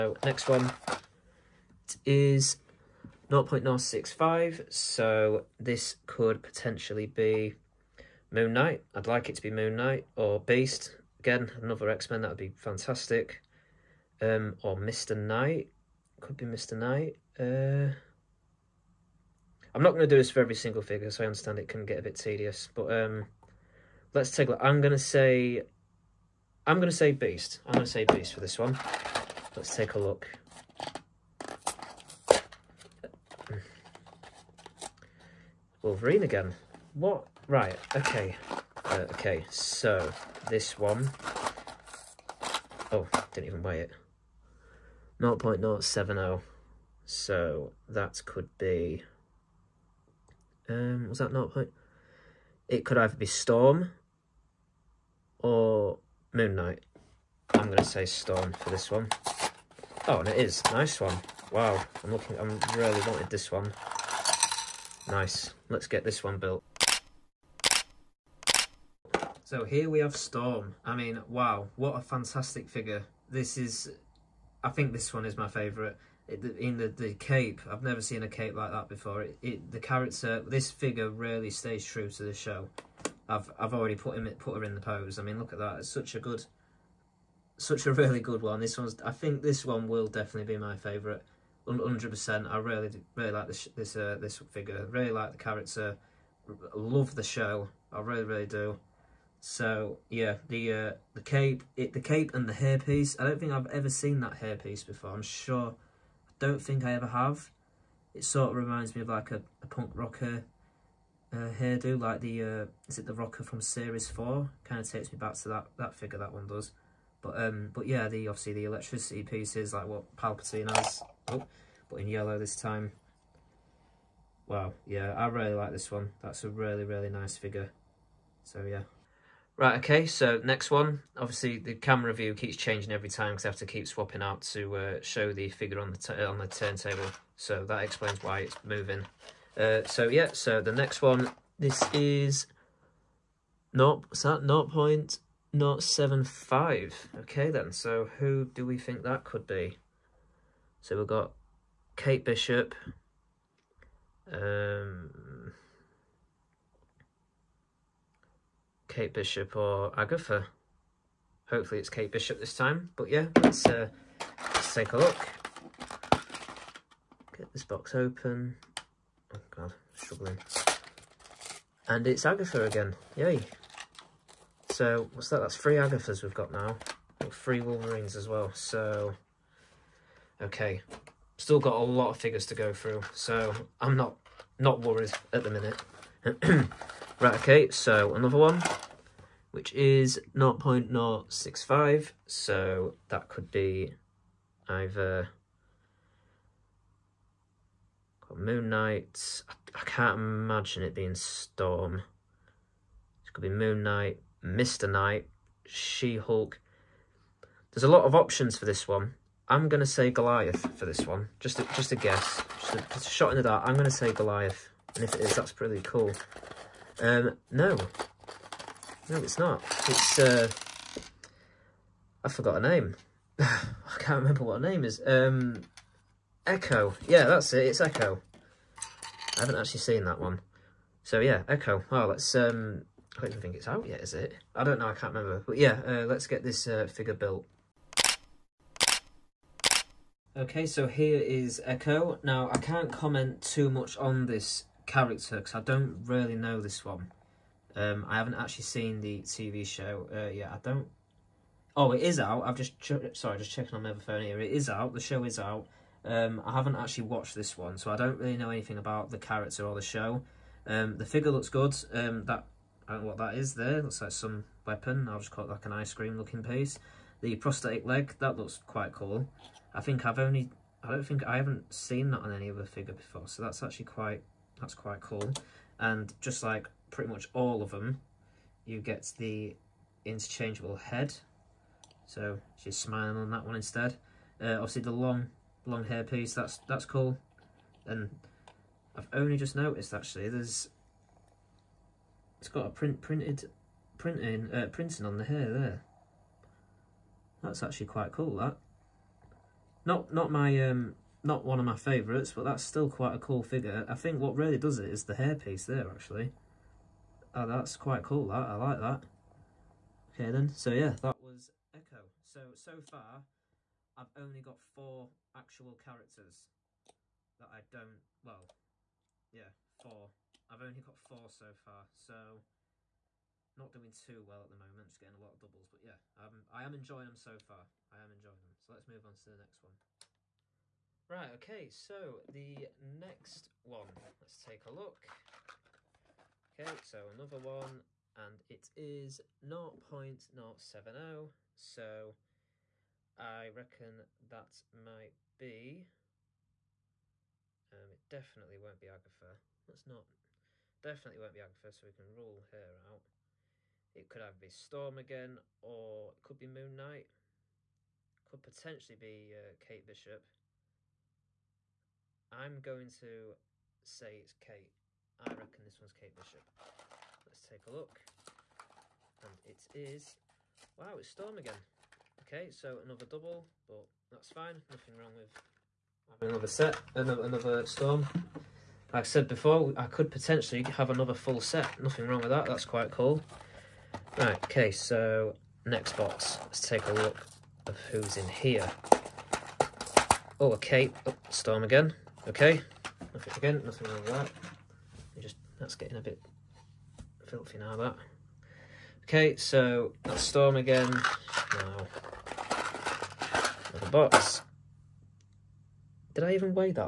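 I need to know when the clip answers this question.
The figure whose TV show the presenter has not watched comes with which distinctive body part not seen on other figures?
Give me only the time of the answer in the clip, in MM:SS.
04:27.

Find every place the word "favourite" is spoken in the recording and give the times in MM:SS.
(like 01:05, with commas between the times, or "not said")
01:15, 01:30, 05:01.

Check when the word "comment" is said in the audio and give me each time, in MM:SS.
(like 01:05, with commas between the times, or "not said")
04:02.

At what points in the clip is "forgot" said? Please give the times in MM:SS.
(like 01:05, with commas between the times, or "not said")
03:42.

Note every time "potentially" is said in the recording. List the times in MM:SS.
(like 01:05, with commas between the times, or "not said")
00:06, 05:58, 06:20.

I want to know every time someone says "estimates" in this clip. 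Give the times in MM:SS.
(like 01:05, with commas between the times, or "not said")
not said.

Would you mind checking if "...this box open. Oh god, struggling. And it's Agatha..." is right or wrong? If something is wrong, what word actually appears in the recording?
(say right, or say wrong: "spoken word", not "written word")
right.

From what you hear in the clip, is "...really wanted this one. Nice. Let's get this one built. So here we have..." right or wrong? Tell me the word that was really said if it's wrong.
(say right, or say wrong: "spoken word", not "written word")
right.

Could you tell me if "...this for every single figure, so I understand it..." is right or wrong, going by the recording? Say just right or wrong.
right.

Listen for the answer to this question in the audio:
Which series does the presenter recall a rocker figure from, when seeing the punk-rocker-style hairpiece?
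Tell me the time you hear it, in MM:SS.
01:53.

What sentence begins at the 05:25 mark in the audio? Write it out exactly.
But yeah, um, I am enjoying them so far.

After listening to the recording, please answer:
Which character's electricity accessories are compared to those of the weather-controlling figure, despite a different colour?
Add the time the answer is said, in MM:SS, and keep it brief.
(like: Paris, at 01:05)
Palpatine, at 02:00.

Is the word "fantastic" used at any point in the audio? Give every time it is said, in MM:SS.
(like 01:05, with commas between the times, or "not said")
00:12, 01:12.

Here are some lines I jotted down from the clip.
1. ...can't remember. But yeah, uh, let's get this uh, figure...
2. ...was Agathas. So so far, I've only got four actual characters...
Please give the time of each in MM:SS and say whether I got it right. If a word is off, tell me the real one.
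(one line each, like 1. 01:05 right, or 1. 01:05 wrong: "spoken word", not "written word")
1. 03:54 right
2. 05:11 wrong: "Echo", not "Agathas".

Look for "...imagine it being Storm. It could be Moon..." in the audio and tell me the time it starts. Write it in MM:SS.
03:20.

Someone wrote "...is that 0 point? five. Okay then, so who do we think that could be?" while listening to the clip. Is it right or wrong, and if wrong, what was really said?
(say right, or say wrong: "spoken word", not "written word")
right.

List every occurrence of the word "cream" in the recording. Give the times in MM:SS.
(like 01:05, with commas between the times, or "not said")
04:25.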